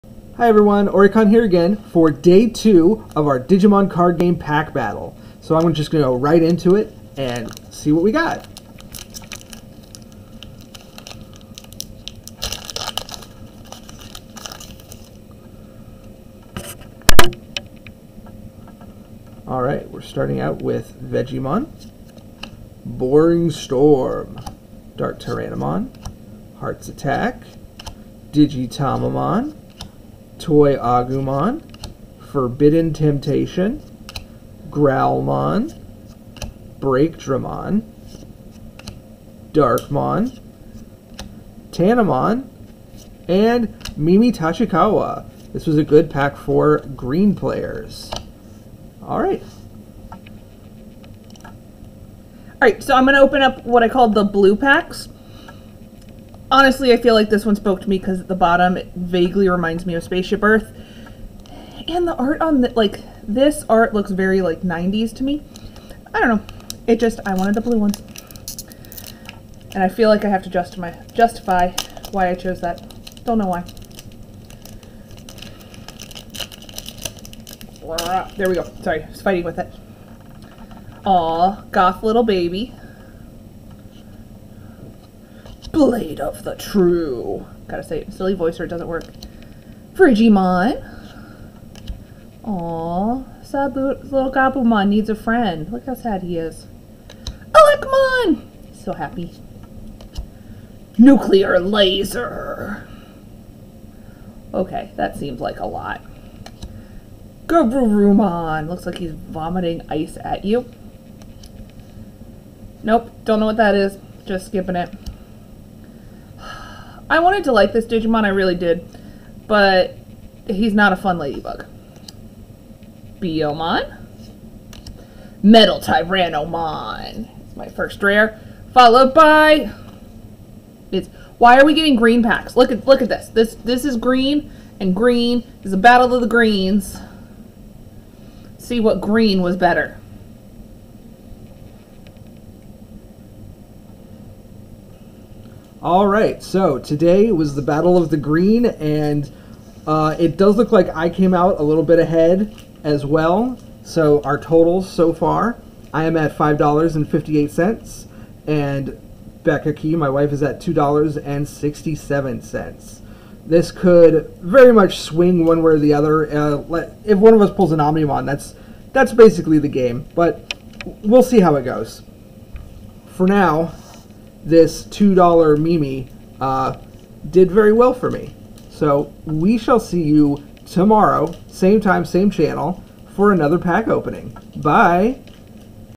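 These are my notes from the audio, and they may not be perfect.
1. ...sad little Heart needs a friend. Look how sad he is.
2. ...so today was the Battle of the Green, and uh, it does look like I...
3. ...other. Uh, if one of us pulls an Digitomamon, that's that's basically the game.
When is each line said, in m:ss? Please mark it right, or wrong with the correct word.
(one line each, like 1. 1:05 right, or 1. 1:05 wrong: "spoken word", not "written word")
1. 1:33 wrong: "Gabumon", not "Heart"
2. 2:26 right
3. 2:45 wrong: "Omnimon", not "Digitomamon".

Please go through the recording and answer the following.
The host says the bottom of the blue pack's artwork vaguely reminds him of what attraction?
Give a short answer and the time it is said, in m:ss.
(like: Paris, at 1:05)
Spaceship Earth, at 1:00.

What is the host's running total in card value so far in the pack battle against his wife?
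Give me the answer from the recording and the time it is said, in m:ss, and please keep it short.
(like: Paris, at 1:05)
$5.58, at 2:36.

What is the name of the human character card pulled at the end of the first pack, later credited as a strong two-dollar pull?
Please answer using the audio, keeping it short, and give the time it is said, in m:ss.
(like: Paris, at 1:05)
Mimi Tachikawa, at 0:43.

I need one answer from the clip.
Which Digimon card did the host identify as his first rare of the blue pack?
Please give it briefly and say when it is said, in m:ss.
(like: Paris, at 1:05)
Metal Tyrannomon, at 2:05.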